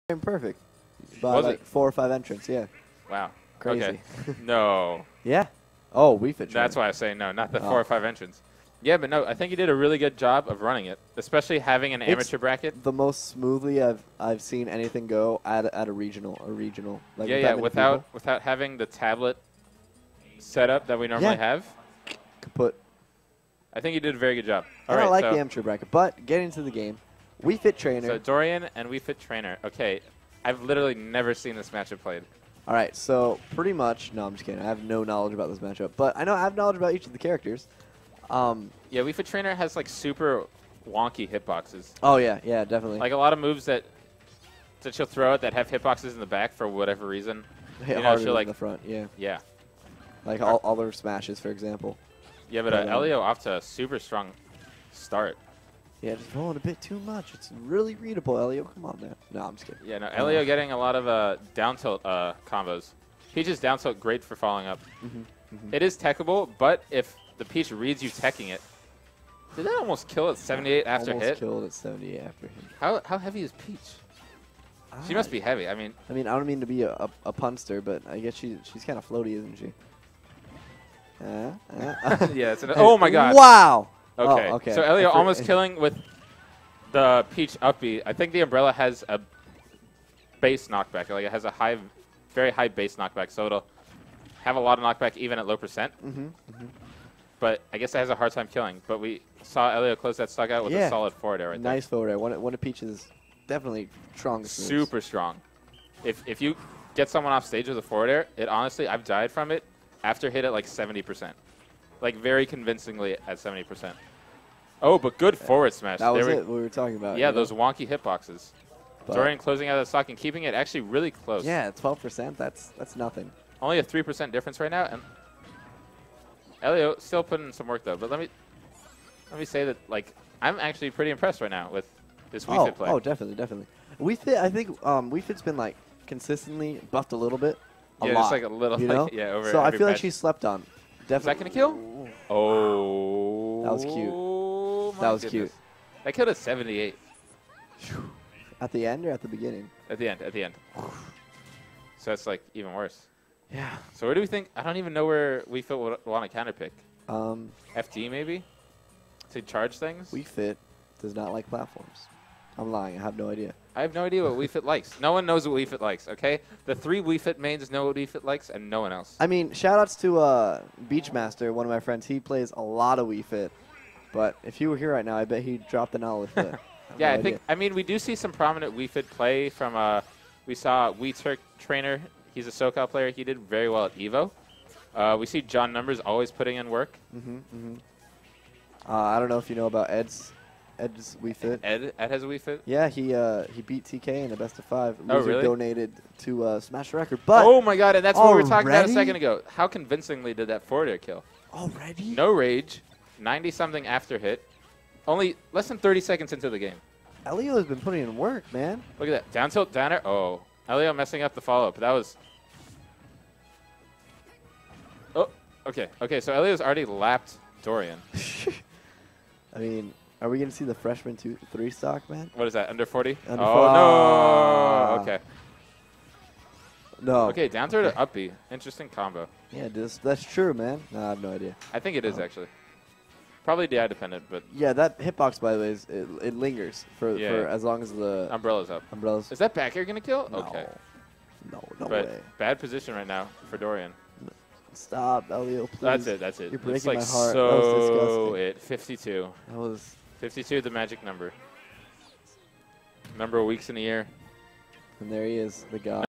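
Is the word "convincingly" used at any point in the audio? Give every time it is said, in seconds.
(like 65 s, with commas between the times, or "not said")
112 s, 199 s.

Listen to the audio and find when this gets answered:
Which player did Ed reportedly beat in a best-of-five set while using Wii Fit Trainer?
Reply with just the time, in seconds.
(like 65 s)
193 s.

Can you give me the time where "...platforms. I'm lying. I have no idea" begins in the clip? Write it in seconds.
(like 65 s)
161 s.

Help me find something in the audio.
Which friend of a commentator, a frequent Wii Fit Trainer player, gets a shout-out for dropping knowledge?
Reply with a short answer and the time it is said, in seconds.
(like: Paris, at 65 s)
Beachmaster, at 170 s.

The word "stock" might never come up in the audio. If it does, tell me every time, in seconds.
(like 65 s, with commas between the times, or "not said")
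100 s, 119 s, 221 s.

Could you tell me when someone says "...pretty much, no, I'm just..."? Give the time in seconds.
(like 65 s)
33 s.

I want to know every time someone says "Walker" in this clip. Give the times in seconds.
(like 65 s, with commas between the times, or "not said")
not said.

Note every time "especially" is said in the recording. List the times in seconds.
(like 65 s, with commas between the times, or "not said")
11 s.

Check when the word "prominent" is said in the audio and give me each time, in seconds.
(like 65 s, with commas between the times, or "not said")
178 s.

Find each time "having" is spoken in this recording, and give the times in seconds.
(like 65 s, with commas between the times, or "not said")
11 s, 18 s.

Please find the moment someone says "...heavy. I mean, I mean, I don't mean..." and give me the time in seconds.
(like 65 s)
75 s.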